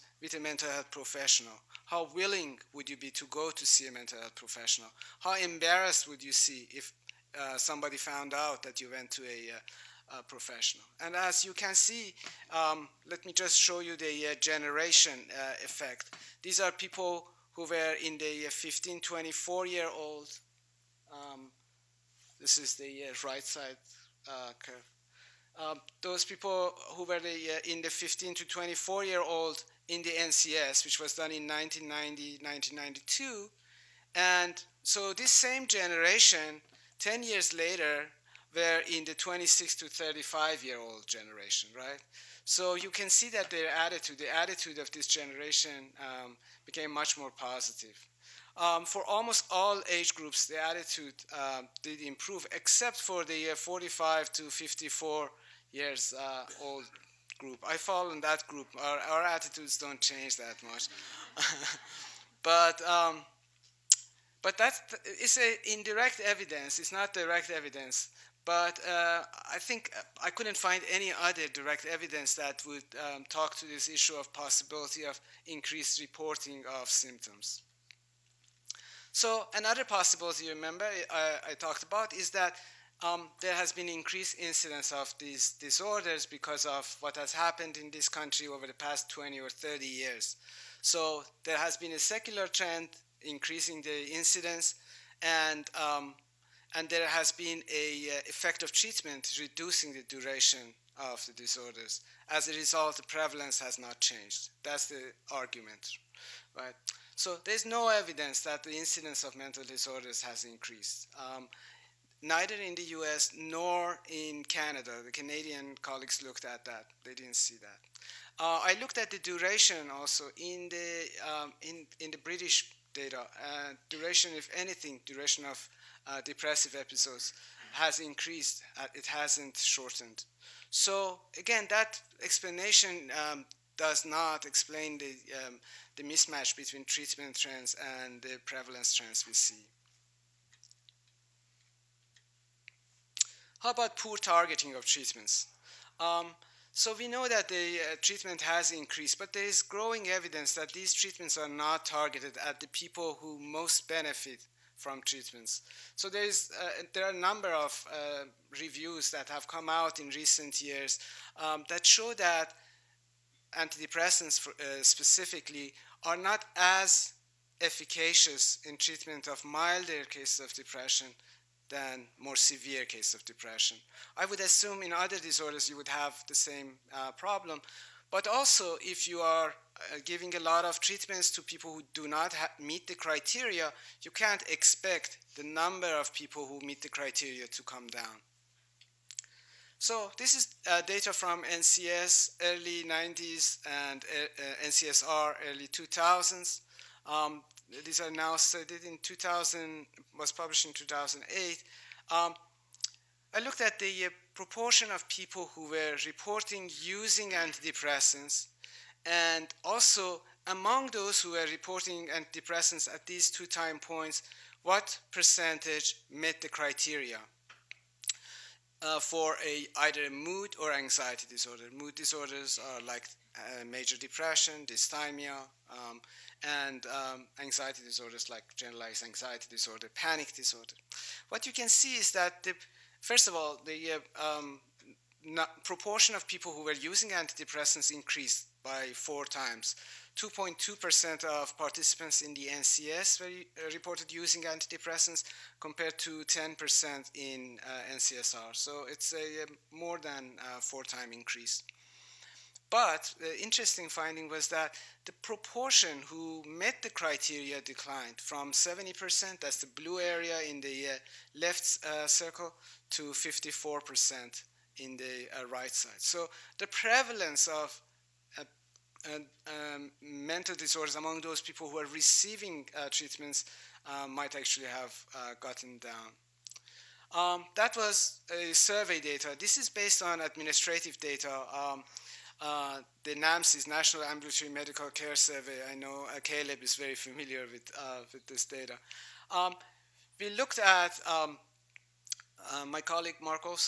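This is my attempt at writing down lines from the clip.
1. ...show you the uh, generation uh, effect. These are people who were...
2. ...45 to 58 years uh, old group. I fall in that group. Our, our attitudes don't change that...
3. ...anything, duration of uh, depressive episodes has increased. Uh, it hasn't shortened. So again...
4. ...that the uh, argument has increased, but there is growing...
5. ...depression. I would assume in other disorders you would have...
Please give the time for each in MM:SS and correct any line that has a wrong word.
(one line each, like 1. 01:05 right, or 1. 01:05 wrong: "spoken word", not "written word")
1. 00:13 right
2. 00:53 wrong: "54", not "58"
3. 02:04 right
4. 02:27 wrong: "treatment", not "argument"
5. 02:53 right.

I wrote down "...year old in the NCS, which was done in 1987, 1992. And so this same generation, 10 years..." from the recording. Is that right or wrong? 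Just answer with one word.
wrong.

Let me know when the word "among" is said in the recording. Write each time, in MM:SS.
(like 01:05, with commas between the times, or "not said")
03:30, 04:30.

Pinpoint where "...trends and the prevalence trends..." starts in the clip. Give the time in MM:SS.
02:17.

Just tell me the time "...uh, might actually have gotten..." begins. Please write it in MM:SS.
04:33.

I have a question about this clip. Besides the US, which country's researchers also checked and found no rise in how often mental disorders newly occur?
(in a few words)
Canada.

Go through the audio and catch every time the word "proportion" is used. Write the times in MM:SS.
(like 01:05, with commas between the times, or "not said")
03:24, 03:55, 04:15.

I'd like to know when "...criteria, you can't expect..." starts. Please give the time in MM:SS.
03:02.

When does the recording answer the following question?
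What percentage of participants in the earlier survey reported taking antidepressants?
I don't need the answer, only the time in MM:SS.
04:00.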